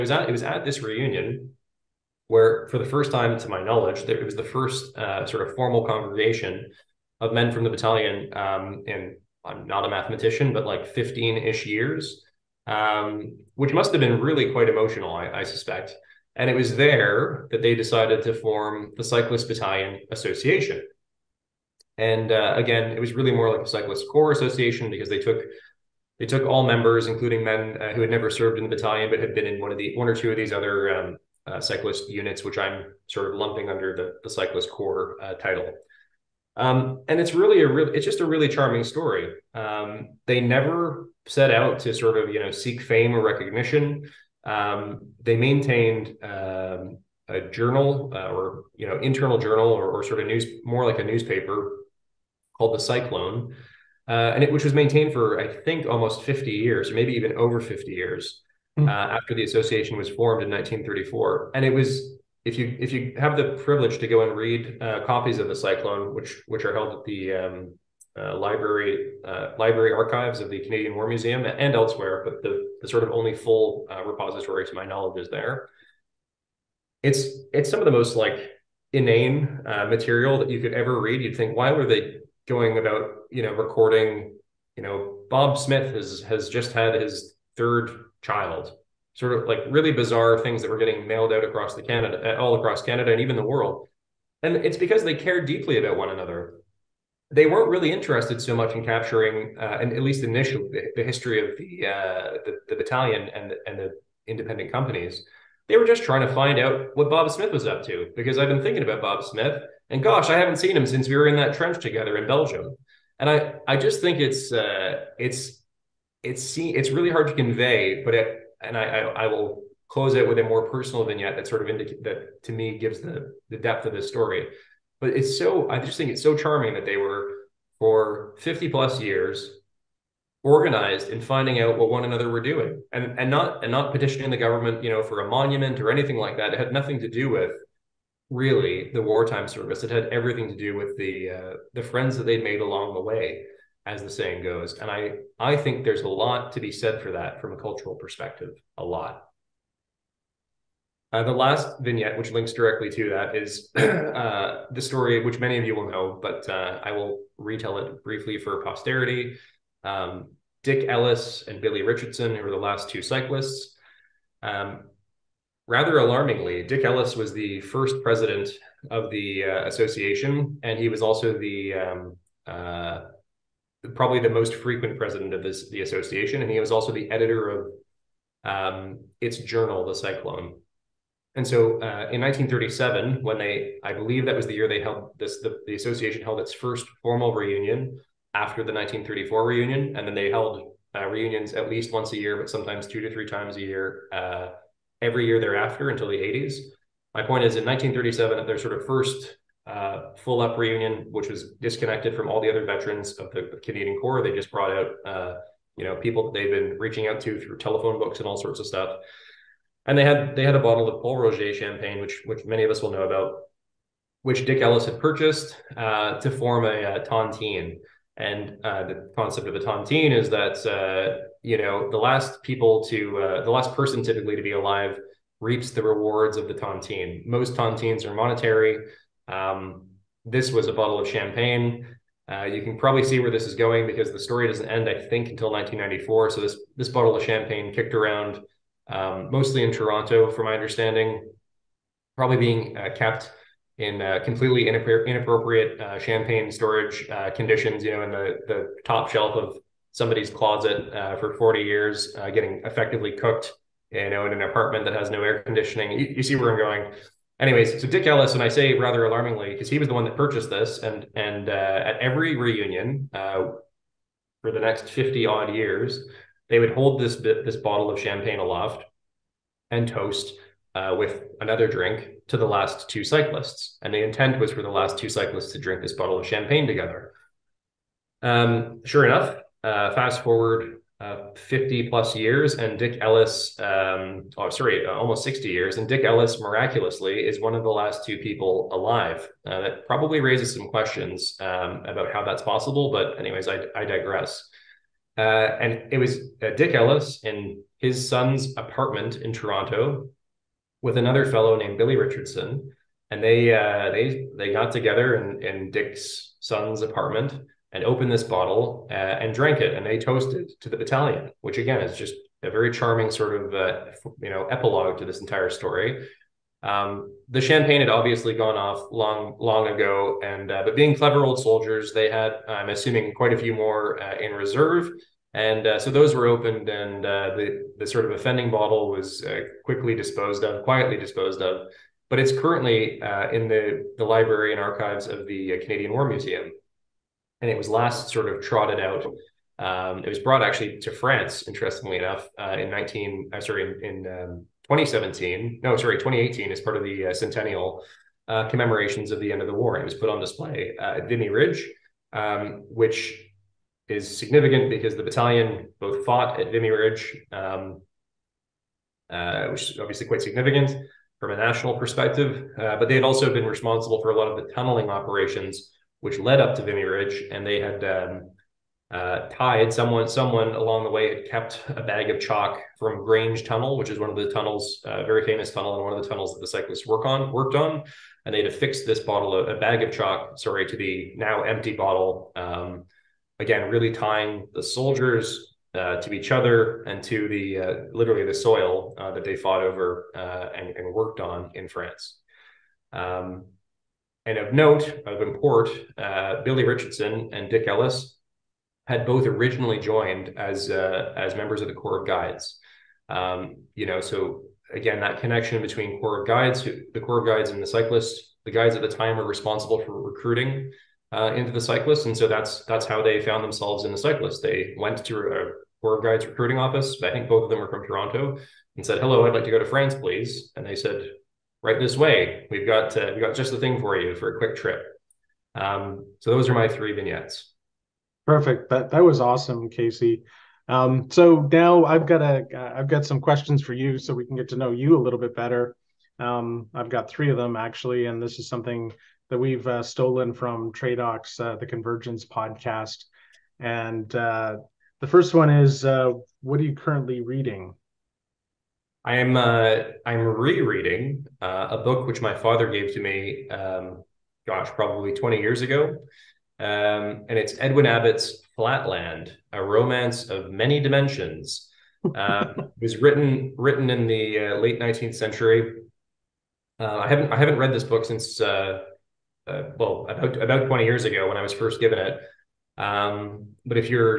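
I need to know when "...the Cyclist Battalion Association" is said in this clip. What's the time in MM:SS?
00:18.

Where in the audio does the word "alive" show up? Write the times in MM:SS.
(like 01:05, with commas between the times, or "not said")
03:44, 04:48.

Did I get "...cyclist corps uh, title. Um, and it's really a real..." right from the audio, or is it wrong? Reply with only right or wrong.
right.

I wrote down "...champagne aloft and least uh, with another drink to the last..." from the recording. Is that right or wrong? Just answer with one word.
wrong.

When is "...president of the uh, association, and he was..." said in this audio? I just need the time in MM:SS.
02:48.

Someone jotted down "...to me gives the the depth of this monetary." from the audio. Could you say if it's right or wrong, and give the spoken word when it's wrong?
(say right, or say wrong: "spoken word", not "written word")
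wrong: "story", not "monetary".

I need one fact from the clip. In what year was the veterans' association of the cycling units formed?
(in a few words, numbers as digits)
1934.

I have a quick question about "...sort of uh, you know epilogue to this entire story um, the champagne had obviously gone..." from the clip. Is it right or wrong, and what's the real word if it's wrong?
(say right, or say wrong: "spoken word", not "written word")
right.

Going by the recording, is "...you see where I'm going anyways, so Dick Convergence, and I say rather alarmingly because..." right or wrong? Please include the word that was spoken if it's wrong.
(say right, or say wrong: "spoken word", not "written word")
wrong: "Ellis", not "Convergence".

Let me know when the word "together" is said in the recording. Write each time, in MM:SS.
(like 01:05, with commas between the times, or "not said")
01:51, 04:36, 05:04.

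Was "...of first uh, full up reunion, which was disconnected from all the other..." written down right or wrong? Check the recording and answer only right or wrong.
right.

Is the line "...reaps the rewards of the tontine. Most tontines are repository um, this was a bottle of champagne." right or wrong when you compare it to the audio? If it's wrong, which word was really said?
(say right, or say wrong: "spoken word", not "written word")
wrong: "monetary", not "repository".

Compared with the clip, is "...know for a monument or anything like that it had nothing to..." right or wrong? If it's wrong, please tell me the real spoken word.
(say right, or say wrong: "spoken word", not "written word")
right.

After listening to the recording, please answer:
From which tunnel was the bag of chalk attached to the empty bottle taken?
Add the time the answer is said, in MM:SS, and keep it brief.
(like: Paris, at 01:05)
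Grange Tunnel, at 06:13.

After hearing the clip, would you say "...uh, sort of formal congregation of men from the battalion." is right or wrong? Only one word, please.
right.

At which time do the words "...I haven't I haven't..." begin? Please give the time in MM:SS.
07:46.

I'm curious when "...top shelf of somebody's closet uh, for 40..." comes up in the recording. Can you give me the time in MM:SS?
04:08.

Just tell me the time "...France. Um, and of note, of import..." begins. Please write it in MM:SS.
06:31.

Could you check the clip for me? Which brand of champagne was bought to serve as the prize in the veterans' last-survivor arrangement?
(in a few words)
Pol Roger.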